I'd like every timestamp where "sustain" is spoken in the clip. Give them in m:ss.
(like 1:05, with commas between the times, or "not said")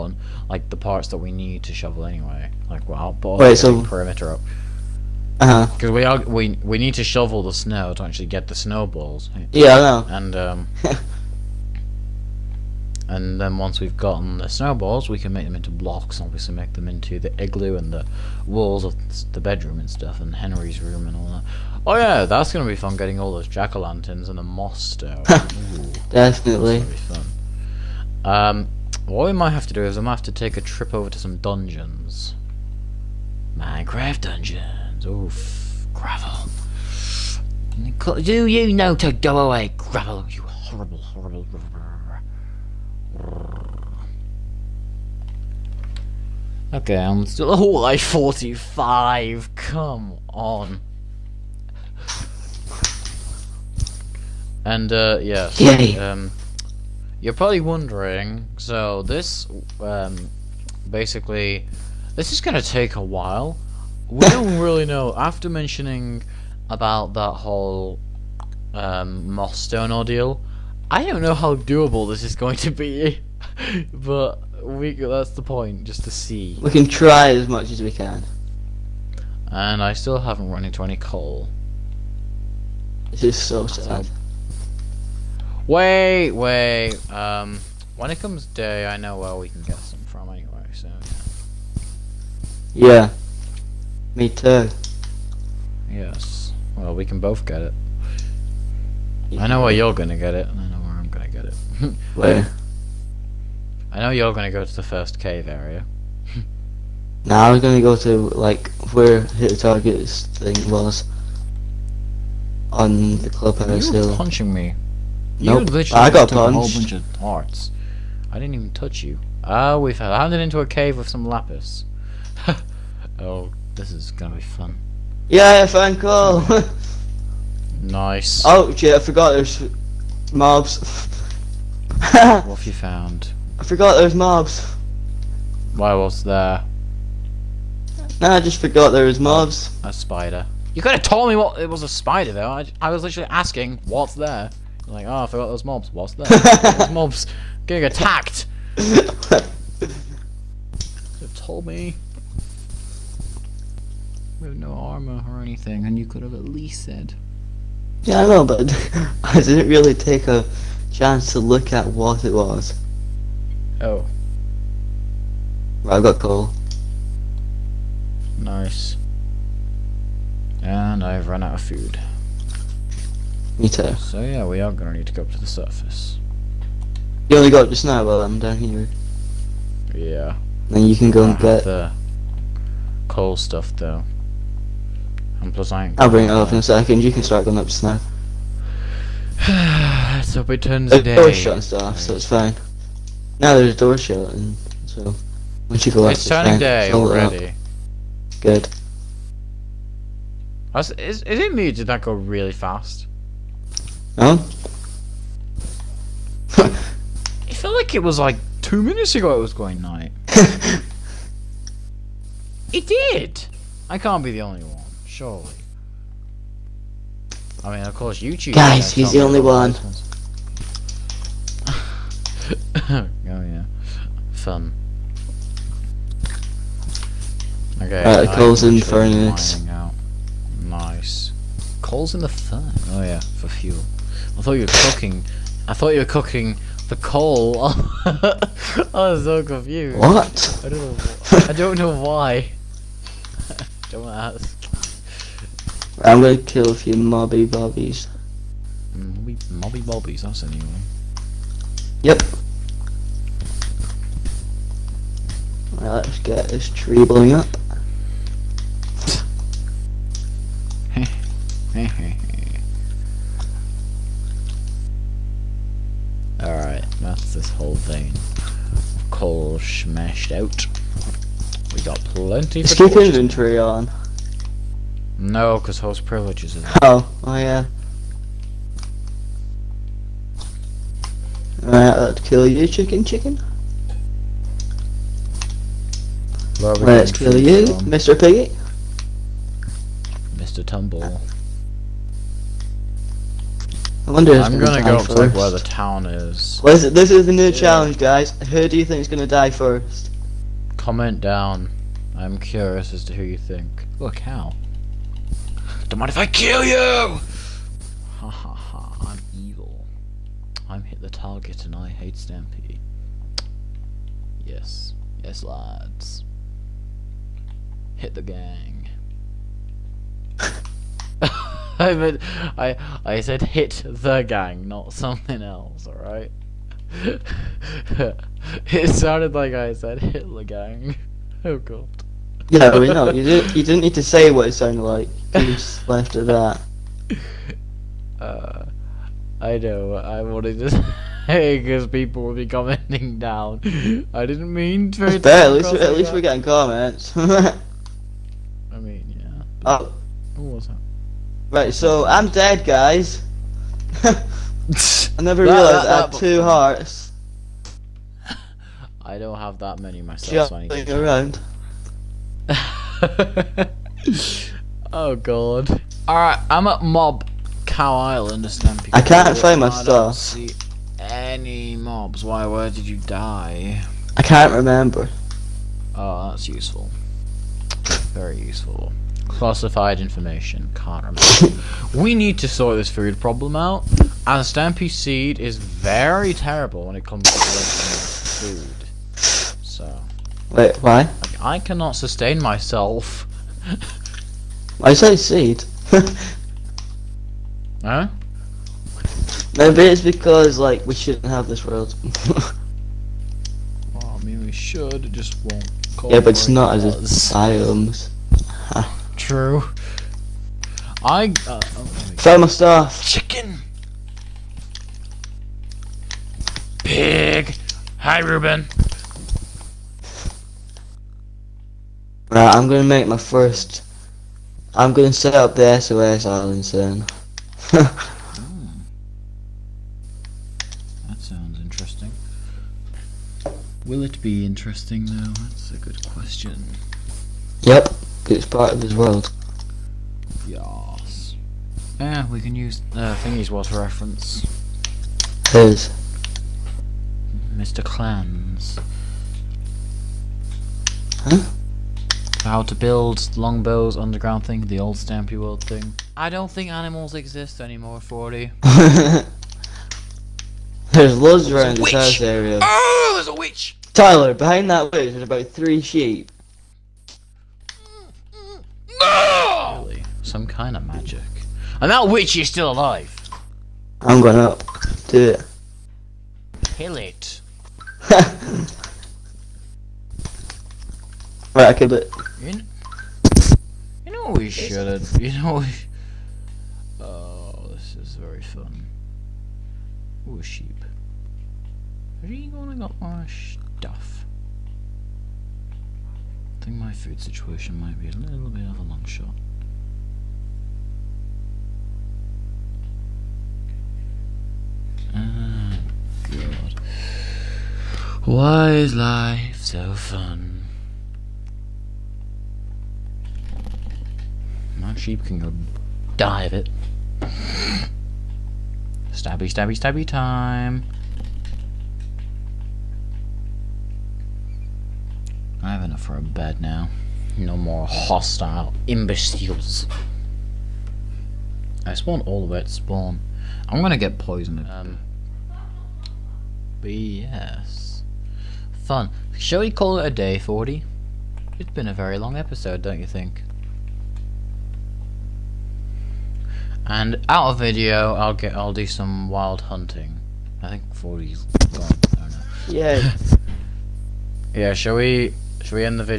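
6:31.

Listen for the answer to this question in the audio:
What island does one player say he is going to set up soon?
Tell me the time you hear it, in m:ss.
7:05.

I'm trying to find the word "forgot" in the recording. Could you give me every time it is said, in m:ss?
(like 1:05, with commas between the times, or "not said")
2:08, 2:13, 2:18, 2:25.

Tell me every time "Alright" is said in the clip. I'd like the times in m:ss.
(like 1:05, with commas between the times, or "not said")
4:41, 6:06.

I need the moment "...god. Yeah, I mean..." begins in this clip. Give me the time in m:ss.
5:31.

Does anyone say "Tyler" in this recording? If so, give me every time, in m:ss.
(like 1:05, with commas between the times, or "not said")
7:43.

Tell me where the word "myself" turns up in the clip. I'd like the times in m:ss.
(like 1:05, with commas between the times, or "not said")
5:59, 6:32.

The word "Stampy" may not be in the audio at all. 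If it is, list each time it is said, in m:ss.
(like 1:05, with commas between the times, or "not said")
5:12, 7:34.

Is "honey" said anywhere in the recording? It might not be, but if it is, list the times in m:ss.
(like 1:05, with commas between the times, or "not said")
not said.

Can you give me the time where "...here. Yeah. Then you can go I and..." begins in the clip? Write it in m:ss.
2:58.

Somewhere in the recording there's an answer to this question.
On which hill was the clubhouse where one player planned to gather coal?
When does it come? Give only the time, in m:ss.
1:53.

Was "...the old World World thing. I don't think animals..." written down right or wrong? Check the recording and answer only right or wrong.
wrong.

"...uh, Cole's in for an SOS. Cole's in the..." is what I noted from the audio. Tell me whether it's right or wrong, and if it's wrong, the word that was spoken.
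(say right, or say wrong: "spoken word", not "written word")
wrong: "Nice", not "SOS".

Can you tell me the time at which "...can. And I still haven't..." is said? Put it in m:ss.
1:17.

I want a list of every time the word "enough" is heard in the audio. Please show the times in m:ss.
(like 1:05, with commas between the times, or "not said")
8:45.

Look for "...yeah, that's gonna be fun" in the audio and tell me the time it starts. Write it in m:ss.
0:21.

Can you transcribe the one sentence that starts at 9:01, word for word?
It's been a very long episode, don't you think?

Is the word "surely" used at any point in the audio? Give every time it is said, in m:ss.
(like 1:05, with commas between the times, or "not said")
3:35.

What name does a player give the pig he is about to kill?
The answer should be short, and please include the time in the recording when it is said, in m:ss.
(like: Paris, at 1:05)
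Mr. Piggy, at 4:47.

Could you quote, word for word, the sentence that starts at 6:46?
Yeah, but it's not as asylums true.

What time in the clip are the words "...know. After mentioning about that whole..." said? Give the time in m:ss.
1:04.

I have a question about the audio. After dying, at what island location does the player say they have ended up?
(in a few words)
Mob Cow Island.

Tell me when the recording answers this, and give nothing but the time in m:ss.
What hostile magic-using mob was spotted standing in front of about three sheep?
7:43.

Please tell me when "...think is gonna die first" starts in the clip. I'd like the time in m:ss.
4:58.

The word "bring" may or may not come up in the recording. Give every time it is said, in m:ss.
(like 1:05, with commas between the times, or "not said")
3:06.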